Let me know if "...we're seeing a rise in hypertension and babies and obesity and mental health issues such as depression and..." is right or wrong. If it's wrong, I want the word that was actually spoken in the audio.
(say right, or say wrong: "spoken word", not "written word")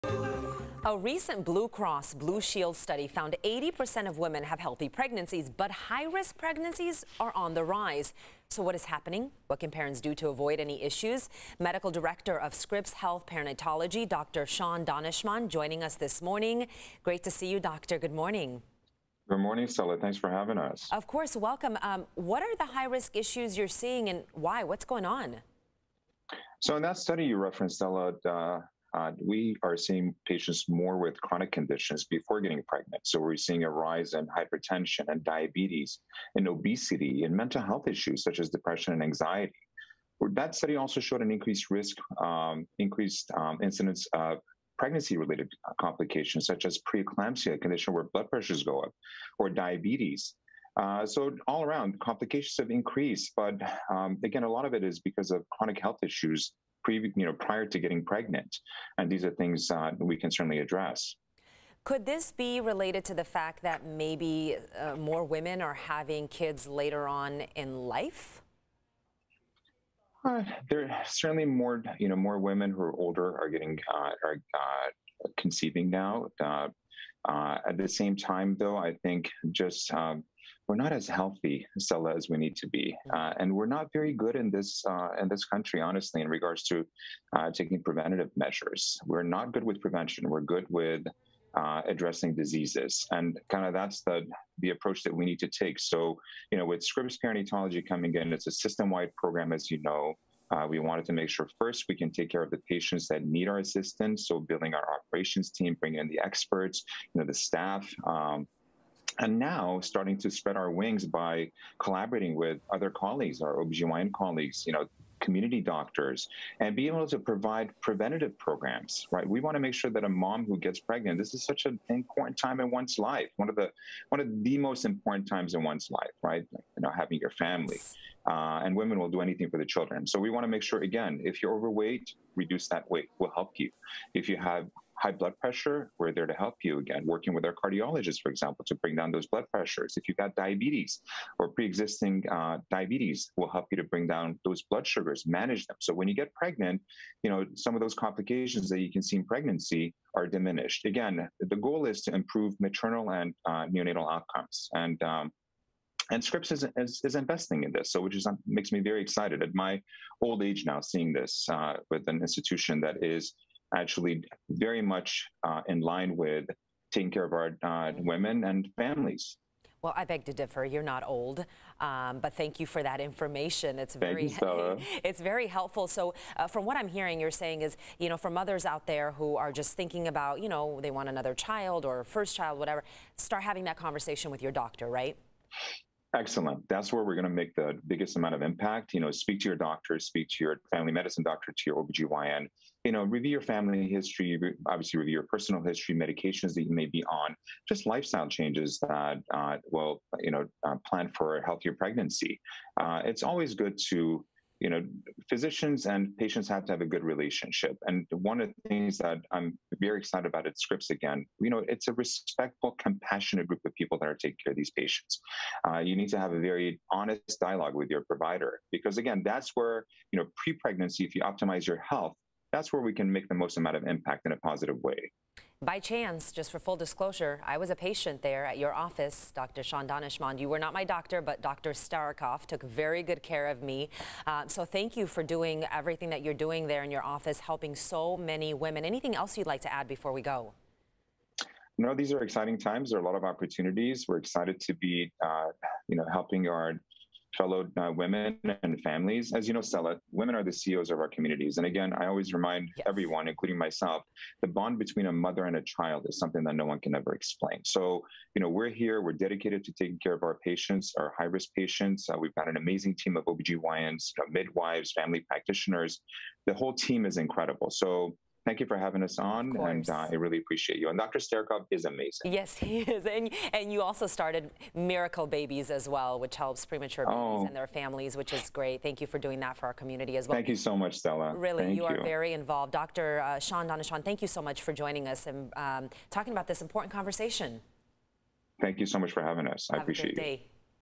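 wrong: "diabetes", not "babies".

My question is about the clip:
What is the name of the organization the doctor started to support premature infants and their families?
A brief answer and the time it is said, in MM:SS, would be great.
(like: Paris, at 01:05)
Miracle Babies, at 04:34.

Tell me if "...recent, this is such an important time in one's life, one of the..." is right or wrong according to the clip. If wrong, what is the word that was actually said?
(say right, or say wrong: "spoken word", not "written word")
wrong: "pregnant", not "recent".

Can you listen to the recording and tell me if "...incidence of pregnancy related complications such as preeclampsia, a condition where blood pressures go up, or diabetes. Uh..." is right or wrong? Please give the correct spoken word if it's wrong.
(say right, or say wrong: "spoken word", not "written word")
right.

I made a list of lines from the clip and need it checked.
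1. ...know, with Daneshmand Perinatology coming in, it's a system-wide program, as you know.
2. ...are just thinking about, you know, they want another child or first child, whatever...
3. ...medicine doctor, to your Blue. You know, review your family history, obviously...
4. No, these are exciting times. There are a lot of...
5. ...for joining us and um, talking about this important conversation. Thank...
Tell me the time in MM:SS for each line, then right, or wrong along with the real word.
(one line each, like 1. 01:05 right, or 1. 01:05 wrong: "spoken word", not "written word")
1. 01:36 wrong: "Scripps", not "Daneshmand"
2. 02:59 right
3. 03:10 wrong: "OBGYN", not "Blue"
4. 04:01 right
5. 04:44 right.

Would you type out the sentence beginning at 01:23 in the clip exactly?
uh, and we're not very good in this uh, in this country, honestly, in regards to uh, taking preventative measures.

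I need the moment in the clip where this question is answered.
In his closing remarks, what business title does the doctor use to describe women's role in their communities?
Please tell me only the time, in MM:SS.
04:10.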